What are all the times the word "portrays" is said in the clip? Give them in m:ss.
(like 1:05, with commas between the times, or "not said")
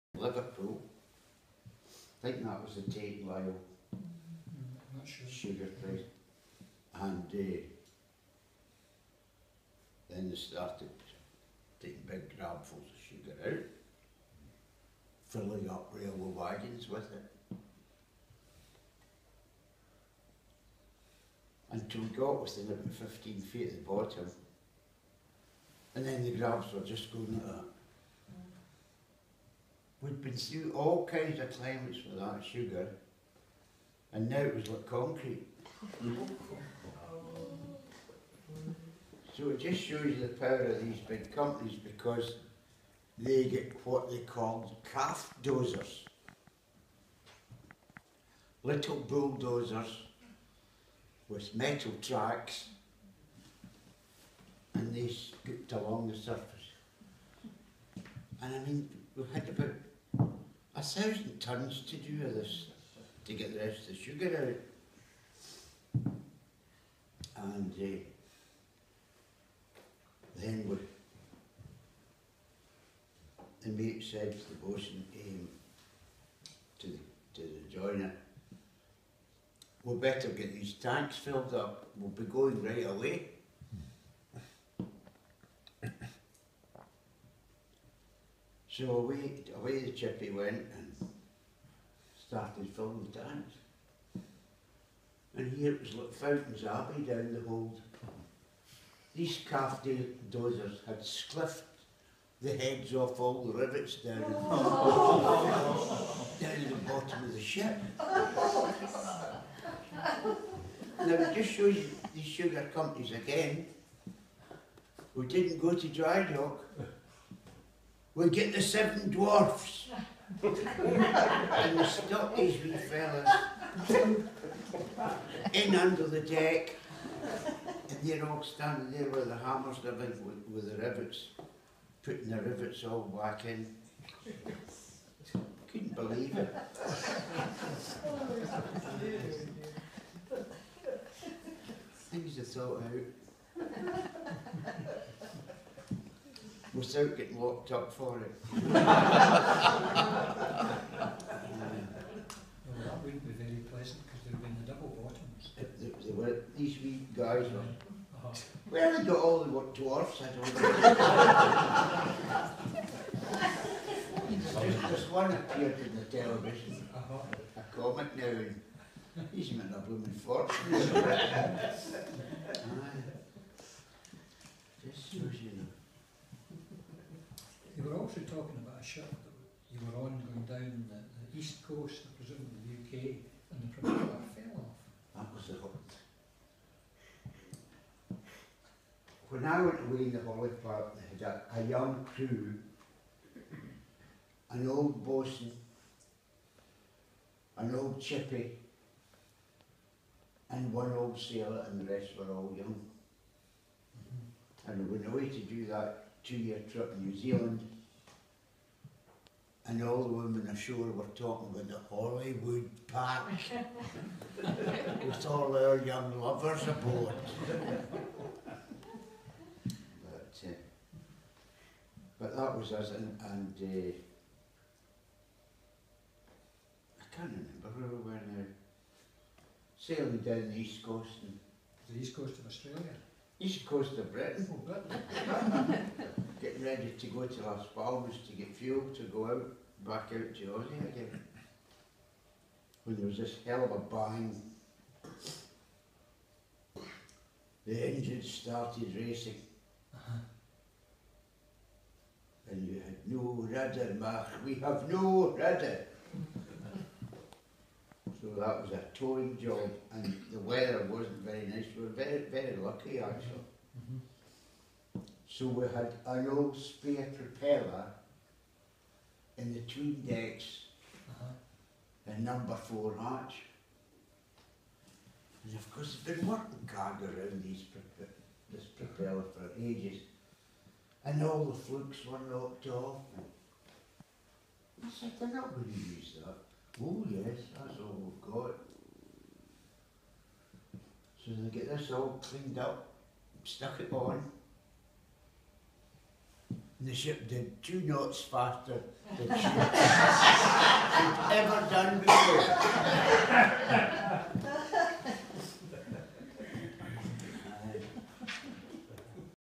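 not said.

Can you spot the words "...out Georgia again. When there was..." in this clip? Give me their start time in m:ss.
4:00.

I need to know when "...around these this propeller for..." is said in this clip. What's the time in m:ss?
4:37.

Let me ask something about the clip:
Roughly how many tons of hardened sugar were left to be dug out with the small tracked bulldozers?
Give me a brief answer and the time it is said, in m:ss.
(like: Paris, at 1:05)
1000, at 1:00.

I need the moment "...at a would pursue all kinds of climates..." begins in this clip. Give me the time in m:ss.
0:27.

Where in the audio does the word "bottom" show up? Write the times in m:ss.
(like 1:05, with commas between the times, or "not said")
0:23, 1:46, 2:35.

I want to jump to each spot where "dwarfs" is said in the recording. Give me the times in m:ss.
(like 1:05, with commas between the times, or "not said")
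1:59, 2:39.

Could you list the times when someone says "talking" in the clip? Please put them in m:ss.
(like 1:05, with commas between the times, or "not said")
2:58, 3:31.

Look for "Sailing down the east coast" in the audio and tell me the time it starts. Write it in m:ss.
3:49.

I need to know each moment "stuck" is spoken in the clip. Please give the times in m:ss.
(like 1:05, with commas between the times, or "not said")
2:01, 4:53.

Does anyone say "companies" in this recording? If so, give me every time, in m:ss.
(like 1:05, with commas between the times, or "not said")
0:41, 1:52.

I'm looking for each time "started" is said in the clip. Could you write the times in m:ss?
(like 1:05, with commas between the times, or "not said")
0:10, 1:32, 4:08.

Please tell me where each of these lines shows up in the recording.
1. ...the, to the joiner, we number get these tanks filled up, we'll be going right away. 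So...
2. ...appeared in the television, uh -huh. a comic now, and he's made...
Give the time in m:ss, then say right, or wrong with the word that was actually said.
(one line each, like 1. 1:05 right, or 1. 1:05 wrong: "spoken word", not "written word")
1. 1:16 wrong: "better", not "number"
2. 2:45 right.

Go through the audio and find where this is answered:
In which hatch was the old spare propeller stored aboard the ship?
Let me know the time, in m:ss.
4:32.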